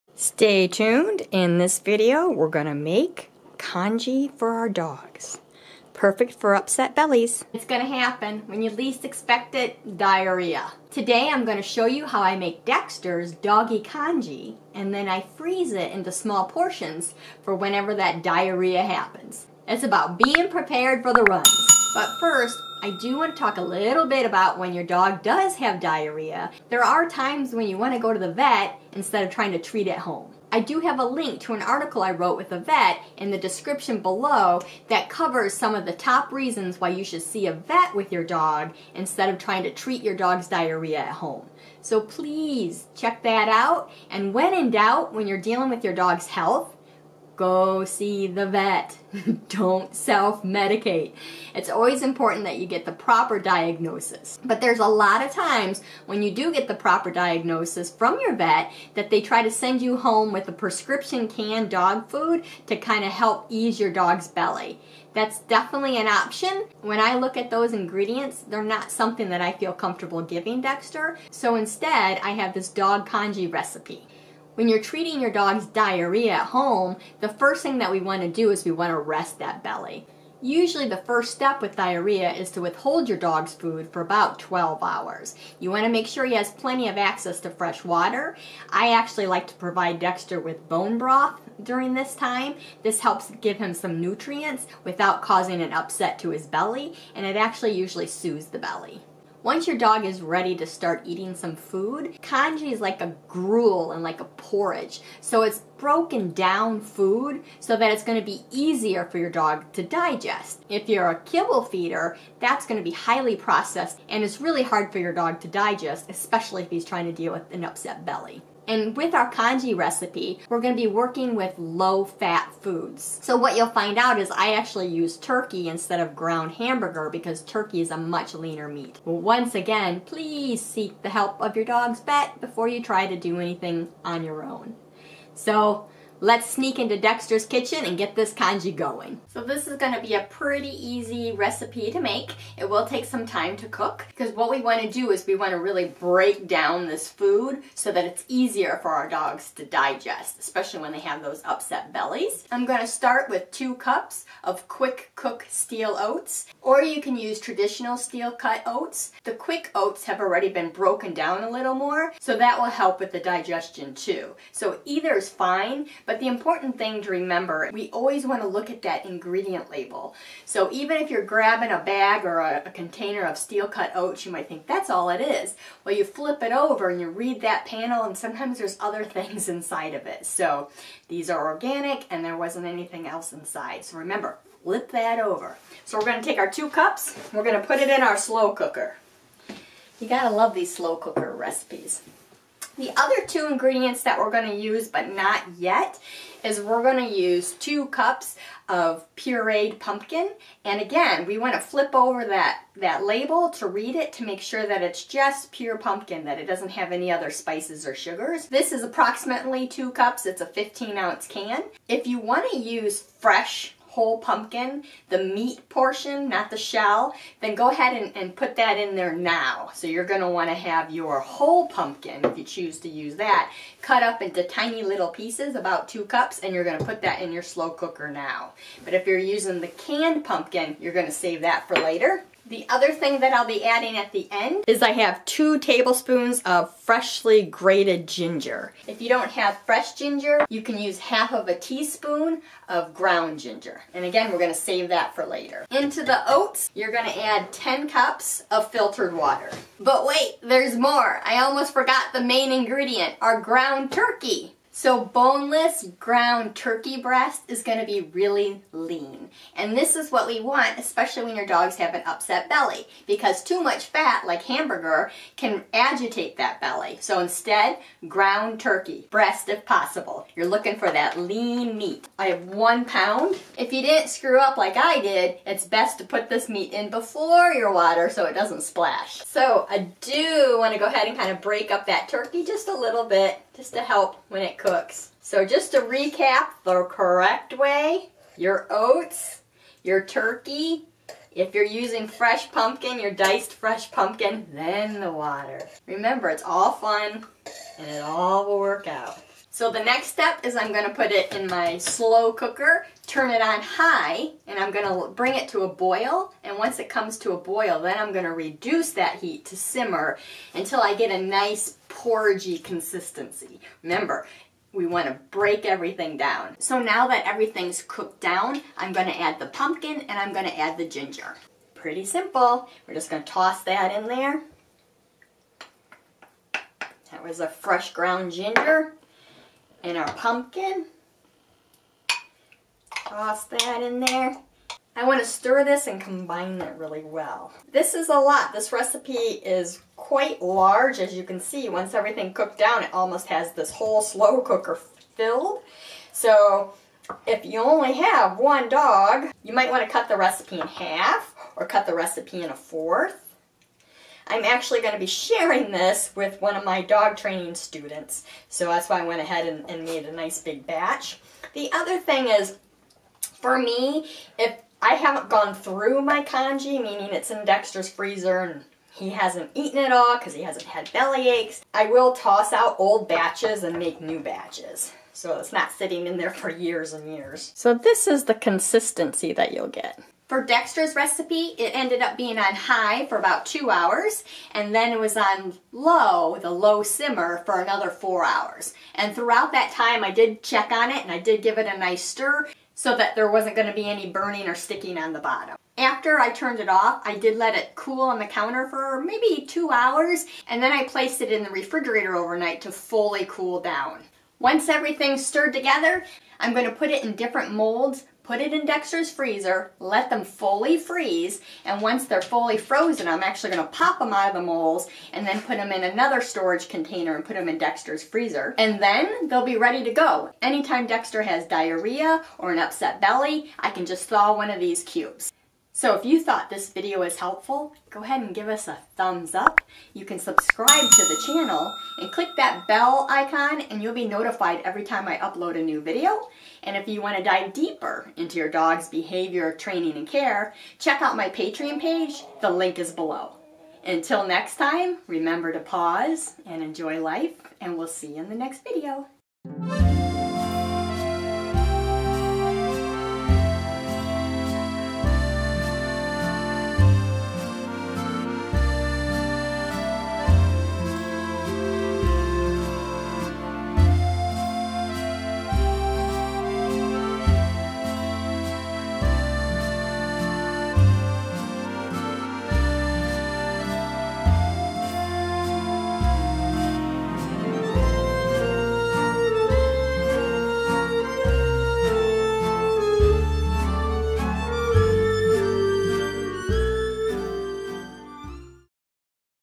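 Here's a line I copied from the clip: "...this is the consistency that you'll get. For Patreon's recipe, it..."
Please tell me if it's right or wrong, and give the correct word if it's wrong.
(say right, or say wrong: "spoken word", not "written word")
wrong: "Dexter", not "Patreon".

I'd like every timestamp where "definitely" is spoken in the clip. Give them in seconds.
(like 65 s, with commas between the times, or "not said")
65 s.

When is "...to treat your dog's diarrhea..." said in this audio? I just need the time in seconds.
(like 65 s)
39 s.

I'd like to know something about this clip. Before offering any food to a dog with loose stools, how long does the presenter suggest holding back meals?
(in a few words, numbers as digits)
12 hours.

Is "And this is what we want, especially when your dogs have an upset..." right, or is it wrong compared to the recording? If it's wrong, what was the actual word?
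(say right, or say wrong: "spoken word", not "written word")
right.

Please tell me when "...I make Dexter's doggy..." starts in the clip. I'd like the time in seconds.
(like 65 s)
12 s.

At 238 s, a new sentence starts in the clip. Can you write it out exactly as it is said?
If you don't have fresh ginger, you can use half of a teaspoon of ground ginger.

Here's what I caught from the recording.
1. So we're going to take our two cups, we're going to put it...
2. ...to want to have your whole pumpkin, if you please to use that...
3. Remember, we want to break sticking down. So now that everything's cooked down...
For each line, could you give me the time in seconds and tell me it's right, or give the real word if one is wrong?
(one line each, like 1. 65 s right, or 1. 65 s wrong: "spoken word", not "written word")
1. 185 s right
2. 220 s wrong: "choose", not "please"
3. 313 s wrong: "everything", not "sticking".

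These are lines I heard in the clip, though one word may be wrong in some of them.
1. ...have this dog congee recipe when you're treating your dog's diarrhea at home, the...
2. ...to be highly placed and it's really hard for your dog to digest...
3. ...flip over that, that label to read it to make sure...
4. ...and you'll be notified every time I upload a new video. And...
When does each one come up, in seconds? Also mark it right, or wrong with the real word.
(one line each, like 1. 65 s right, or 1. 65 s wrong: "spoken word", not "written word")
1. 72 s right
2. 112 s wrong: "processed", not "placed"
3. 201 s right
4. 433 s right.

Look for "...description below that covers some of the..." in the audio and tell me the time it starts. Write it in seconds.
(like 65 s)
33 s.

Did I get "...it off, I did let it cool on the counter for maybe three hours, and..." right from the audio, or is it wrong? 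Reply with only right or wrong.
wrong.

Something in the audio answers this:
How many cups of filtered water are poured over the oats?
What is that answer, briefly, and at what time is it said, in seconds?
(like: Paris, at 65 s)
10, at 247 s.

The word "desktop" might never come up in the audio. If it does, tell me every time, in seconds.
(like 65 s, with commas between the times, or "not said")
not said.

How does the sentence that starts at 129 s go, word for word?
Once again, please seek the help of your dog's vet before you try to do anything on your own.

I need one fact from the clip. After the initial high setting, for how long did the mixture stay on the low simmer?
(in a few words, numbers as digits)
4 hours.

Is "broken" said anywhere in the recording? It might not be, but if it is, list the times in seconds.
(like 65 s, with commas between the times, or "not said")
105 s, 160 s.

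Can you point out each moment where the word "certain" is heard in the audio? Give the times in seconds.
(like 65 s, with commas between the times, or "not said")
not said.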